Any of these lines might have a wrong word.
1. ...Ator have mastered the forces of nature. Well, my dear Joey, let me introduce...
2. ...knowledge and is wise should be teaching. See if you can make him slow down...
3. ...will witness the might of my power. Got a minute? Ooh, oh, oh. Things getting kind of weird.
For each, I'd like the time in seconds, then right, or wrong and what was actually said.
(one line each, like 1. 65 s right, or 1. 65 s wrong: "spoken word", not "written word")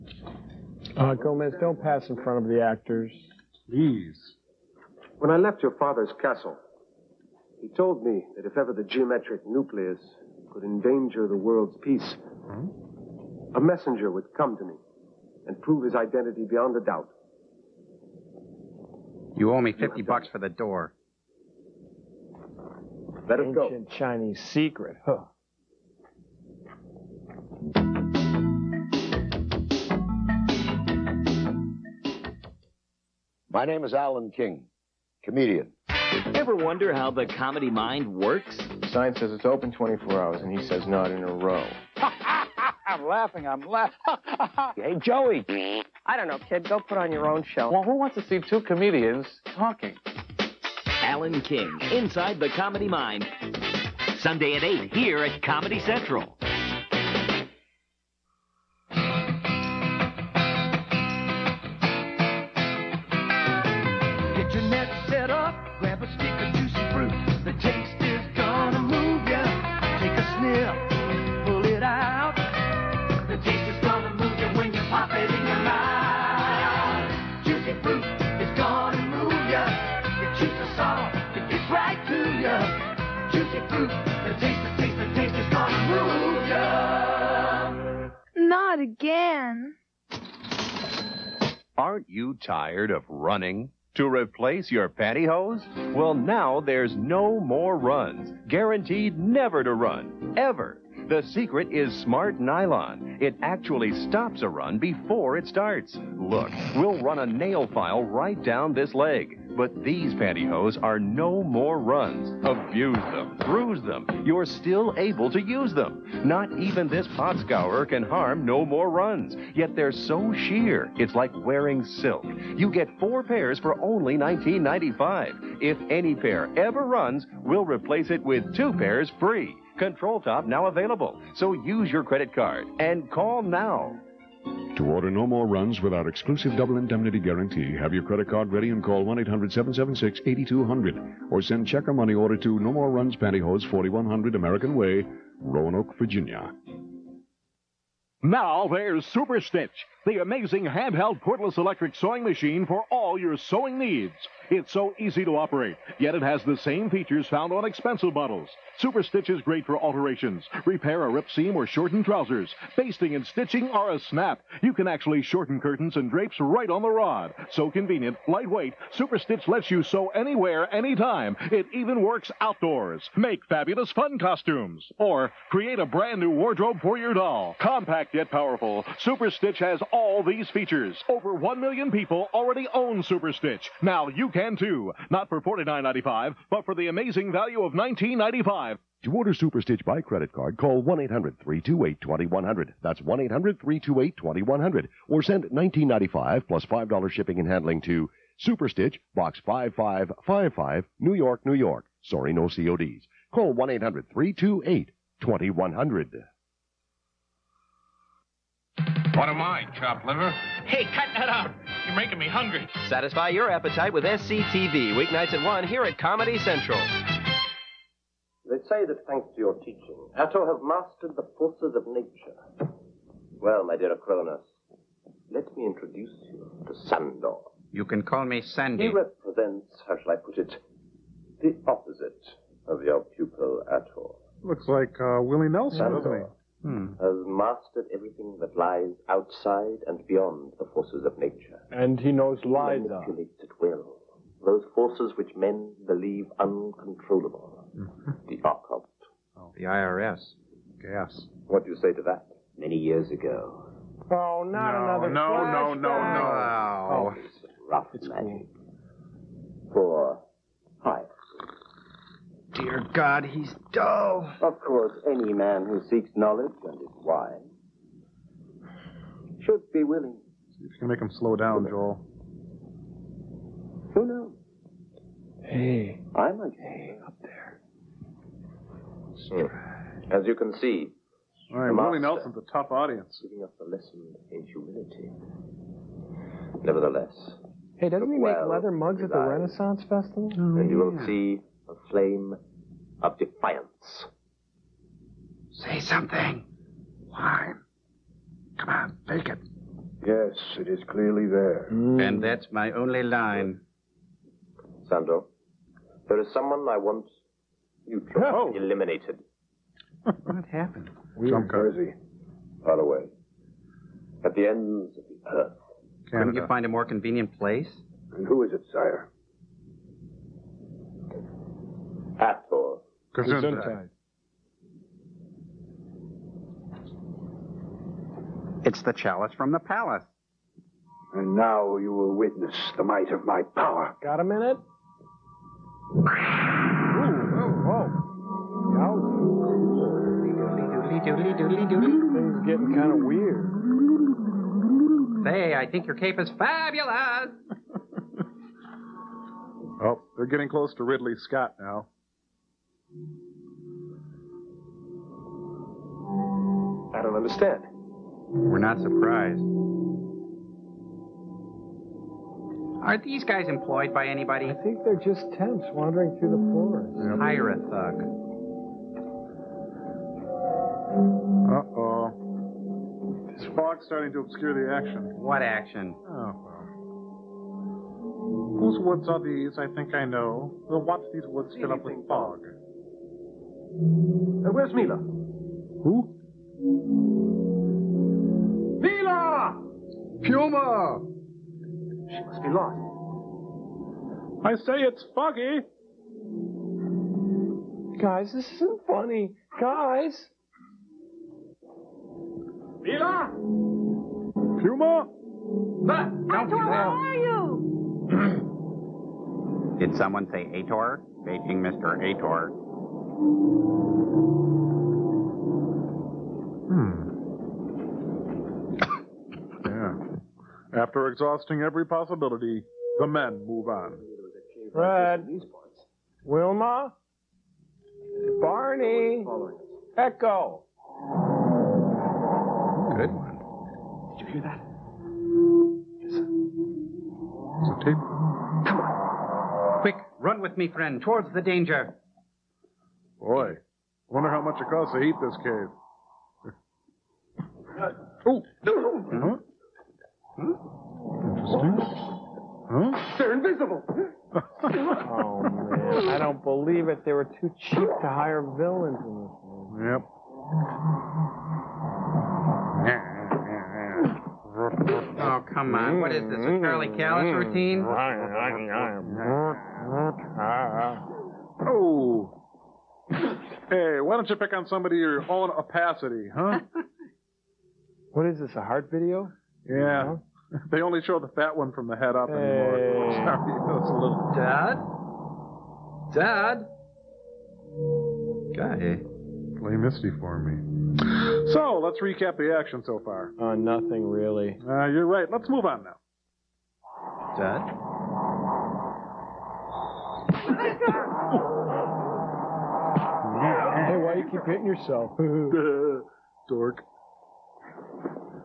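1. 220 s wrong: "Acronis", not "Joey"
2. 266 s wrong: "willing", not "teaching"
3. 331 s right.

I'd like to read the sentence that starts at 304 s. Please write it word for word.
Sandro, there is someone I want you to no.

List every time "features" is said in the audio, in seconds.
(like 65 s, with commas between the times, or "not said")
156 s, 180 s.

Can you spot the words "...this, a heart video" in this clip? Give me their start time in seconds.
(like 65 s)
478 s.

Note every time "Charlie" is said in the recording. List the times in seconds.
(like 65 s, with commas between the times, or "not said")
466 s.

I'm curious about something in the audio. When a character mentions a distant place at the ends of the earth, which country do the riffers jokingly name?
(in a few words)
Canada.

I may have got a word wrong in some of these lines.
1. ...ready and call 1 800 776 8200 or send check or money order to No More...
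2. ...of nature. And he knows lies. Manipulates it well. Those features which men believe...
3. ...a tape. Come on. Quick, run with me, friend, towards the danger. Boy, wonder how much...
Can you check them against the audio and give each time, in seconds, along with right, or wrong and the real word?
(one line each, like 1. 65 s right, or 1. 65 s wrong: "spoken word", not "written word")
1. 138 s right
2. 241 s wrong: "forces", not "features"
3. 437 s right.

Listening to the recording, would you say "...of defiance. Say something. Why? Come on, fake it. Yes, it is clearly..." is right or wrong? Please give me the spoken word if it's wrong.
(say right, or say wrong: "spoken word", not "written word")
right.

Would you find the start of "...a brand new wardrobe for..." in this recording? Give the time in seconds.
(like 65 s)
175 s.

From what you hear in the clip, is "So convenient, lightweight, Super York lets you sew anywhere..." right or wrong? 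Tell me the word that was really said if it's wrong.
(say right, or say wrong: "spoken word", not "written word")
wrong: "Stitch", not "York".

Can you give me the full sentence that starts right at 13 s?
a messenger would come to me and prove his identity beyond a doubt.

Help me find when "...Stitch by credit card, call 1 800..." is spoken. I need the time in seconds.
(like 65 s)
189 s.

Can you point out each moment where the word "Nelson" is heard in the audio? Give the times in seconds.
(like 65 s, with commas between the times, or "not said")
235 s, 281 s.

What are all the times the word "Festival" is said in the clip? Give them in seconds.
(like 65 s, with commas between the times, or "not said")
289 s.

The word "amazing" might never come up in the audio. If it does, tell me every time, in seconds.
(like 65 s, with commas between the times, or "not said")
150 s, 186 s.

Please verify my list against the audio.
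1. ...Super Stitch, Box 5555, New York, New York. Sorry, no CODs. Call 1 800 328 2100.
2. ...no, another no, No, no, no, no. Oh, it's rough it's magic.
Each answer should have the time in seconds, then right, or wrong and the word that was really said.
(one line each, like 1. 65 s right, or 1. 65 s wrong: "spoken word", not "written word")
1. 198 s right
2. 254 s right.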